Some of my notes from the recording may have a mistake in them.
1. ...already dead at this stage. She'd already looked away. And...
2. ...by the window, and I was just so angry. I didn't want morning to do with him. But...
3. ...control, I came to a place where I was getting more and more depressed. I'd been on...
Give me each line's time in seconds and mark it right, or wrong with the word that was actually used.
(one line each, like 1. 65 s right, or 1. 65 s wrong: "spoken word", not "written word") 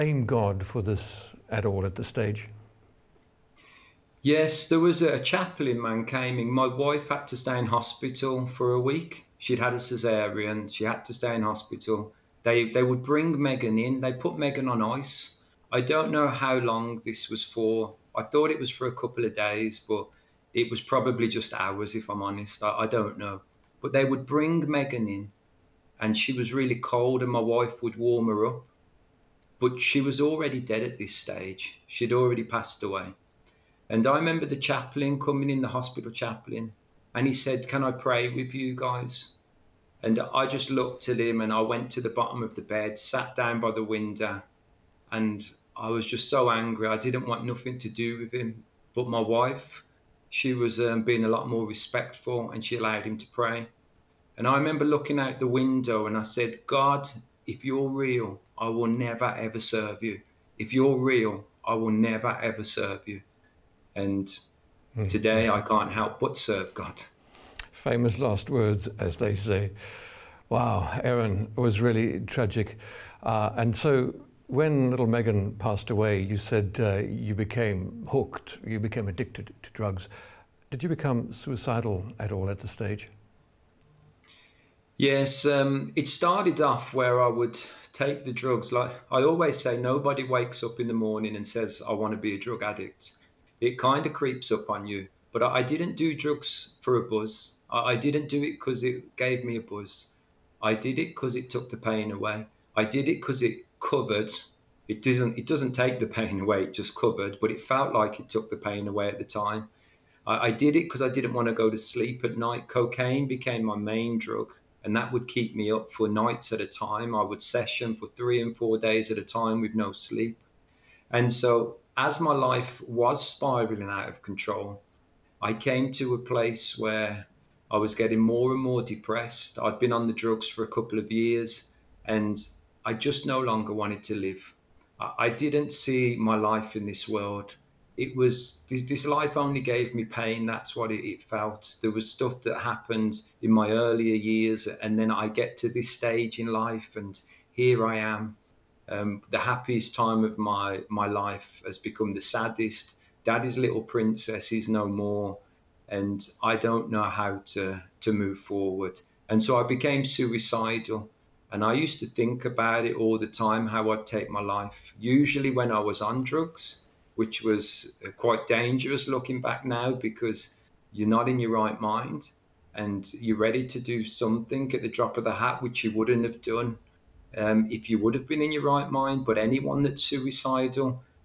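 1. 30 s wrong: "passed", not "looked"
2. 43 s wrong: "nothing", not "morning"
3. 124 s right.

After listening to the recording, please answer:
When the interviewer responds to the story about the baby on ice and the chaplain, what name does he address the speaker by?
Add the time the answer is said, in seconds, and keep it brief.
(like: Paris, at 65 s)
Aaron, at 71 s.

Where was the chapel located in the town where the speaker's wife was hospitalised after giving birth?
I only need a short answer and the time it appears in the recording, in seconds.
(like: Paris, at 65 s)
Mankaming, at 5 s.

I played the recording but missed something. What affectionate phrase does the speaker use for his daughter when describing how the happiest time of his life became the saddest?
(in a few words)
Daddy's little princess.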